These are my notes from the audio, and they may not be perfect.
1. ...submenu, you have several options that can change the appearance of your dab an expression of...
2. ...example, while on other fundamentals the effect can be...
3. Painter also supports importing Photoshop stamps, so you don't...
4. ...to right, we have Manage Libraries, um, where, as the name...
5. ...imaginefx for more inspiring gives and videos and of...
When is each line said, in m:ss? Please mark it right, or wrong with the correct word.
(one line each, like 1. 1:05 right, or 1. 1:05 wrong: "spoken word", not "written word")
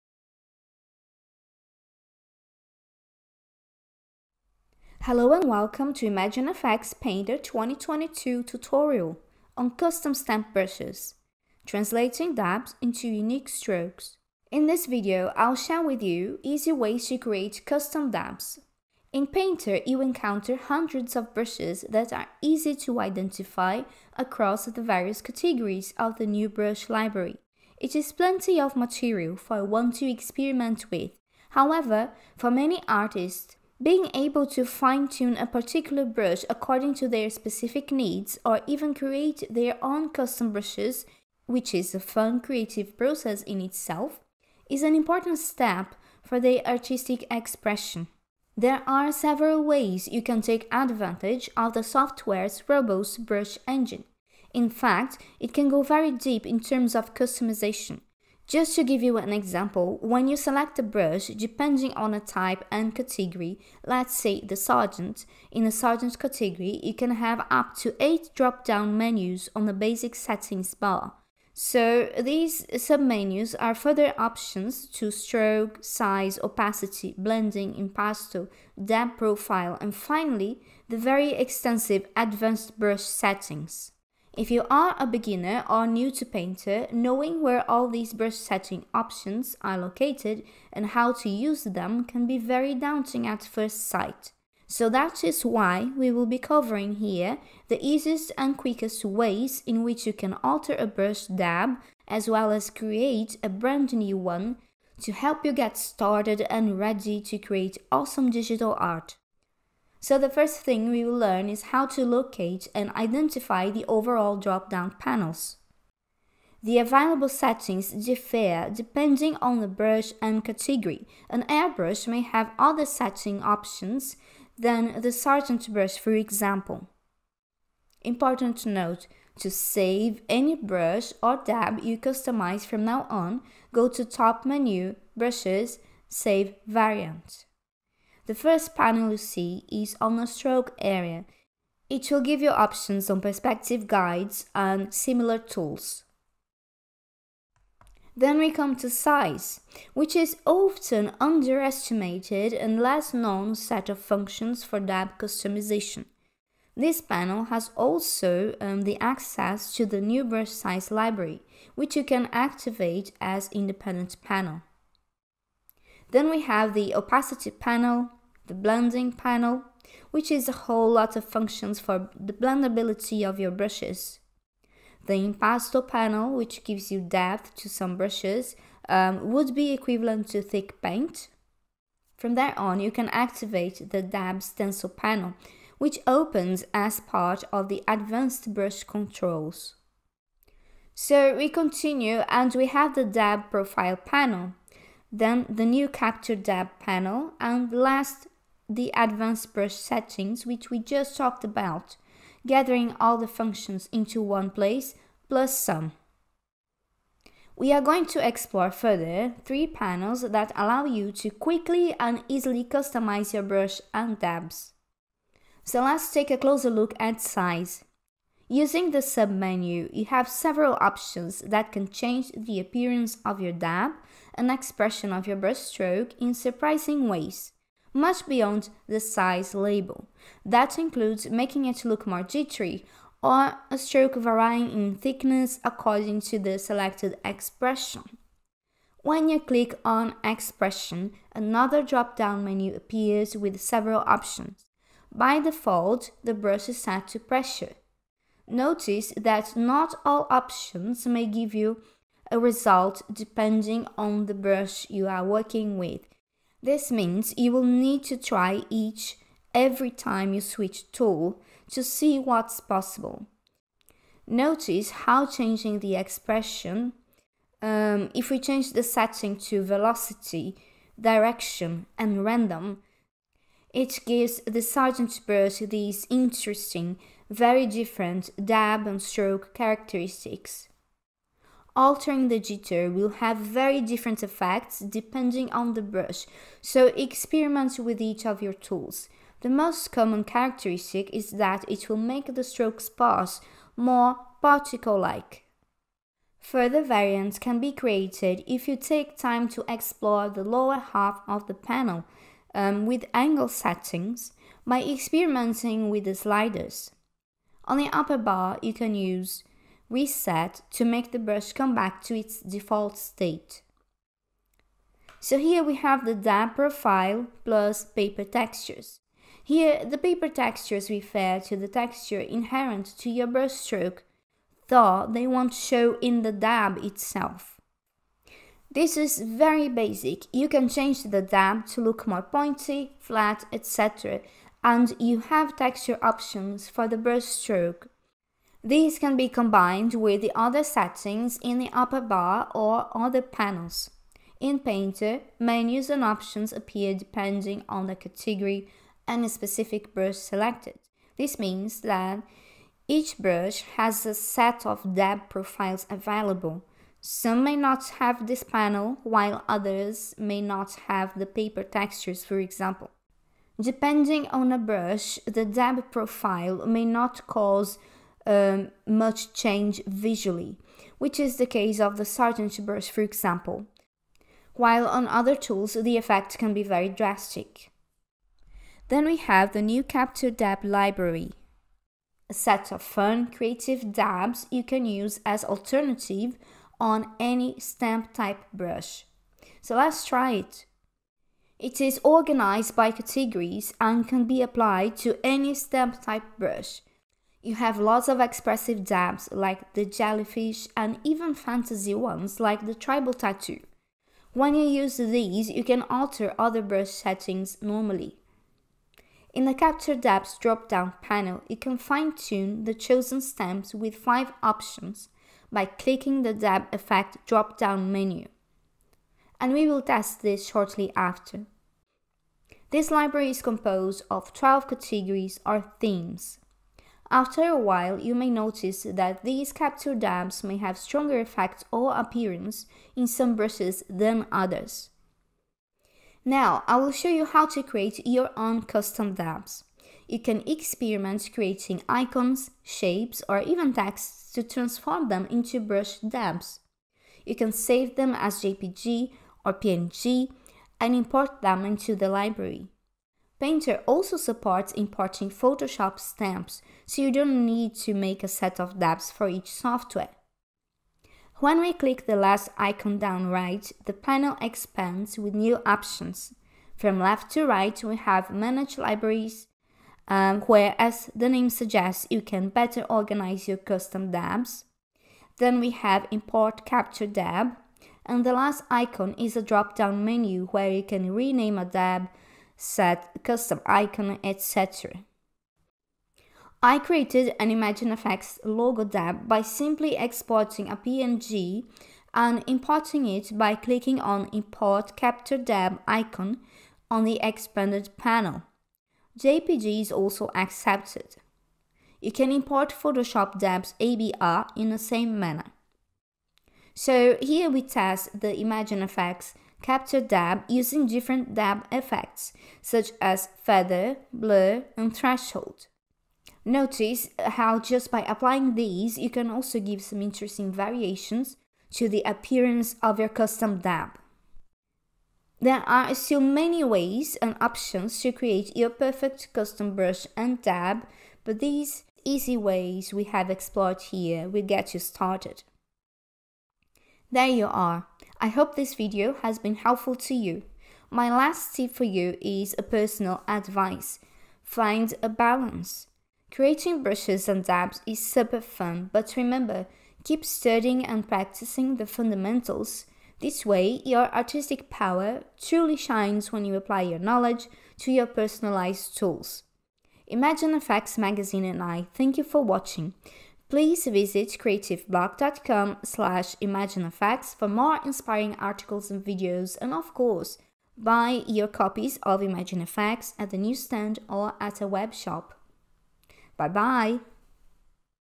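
1. 3:38 right
2. 6:13 wrong: "tools", not "fundamentals"
3. 7:33 right
4. 7:47 right
5. 9:26 wrong: "articles", not "gives".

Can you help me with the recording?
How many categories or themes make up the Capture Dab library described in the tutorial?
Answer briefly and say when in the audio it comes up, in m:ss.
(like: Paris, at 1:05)
12, at 7:04.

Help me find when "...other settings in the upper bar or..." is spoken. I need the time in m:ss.
5:40.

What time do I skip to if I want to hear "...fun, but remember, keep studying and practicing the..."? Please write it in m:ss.
9:08.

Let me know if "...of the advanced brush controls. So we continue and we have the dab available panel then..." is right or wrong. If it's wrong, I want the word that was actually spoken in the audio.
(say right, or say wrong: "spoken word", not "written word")
wrong: "profile", not "available".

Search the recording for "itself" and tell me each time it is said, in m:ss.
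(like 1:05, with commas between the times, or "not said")
0:43, 5:26.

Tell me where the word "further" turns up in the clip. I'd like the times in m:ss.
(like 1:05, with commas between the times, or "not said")
1:13, 3:28, 4:56.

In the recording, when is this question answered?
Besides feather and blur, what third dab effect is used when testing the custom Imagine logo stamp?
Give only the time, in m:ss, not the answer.
8:34.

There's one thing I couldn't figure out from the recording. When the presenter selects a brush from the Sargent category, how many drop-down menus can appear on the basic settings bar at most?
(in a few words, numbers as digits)
8.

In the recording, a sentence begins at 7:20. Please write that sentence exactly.
You can experiment creating icons, shapes, or even texts to transform them into brush dabs.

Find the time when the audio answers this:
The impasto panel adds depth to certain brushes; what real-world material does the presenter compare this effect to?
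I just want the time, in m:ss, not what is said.
3:00.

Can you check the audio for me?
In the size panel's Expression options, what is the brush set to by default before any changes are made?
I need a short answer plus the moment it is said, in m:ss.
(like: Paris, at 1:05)
Pressure, at 4:07.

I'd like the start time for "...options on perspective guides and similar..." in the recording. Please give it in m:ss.
2:22.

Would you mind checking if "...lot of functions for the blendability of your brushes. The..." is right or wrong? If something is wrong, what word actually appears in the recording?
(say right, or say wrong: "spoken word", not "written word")
right.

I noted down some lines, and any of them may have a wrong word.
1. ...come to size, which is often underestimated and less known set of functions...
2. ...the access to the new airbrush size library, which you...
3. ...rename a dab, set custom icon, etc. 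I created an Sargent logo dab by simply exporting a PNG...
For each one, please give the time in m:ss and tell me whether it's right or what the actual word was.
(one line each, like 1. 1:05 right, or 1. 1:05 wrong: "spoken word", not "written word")
1. 2:28 right
2. 2:38 wrong: "brush", not "airbrush"
3. 8:01 wrong: "Imagine", not "Sargent".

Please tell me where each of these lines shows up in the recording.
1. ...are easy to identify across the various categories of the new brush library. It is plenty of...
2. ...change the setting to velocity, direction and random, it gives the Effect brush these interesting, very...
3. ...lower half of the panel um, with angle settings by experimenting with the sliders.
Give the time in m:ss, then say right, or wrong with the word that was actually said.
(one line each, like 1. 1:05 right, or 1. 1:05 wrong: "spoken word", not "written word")
1. 0:22 right
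2. 4:28 wrong: "Sargent", not "Effect"
3. 5:00 right.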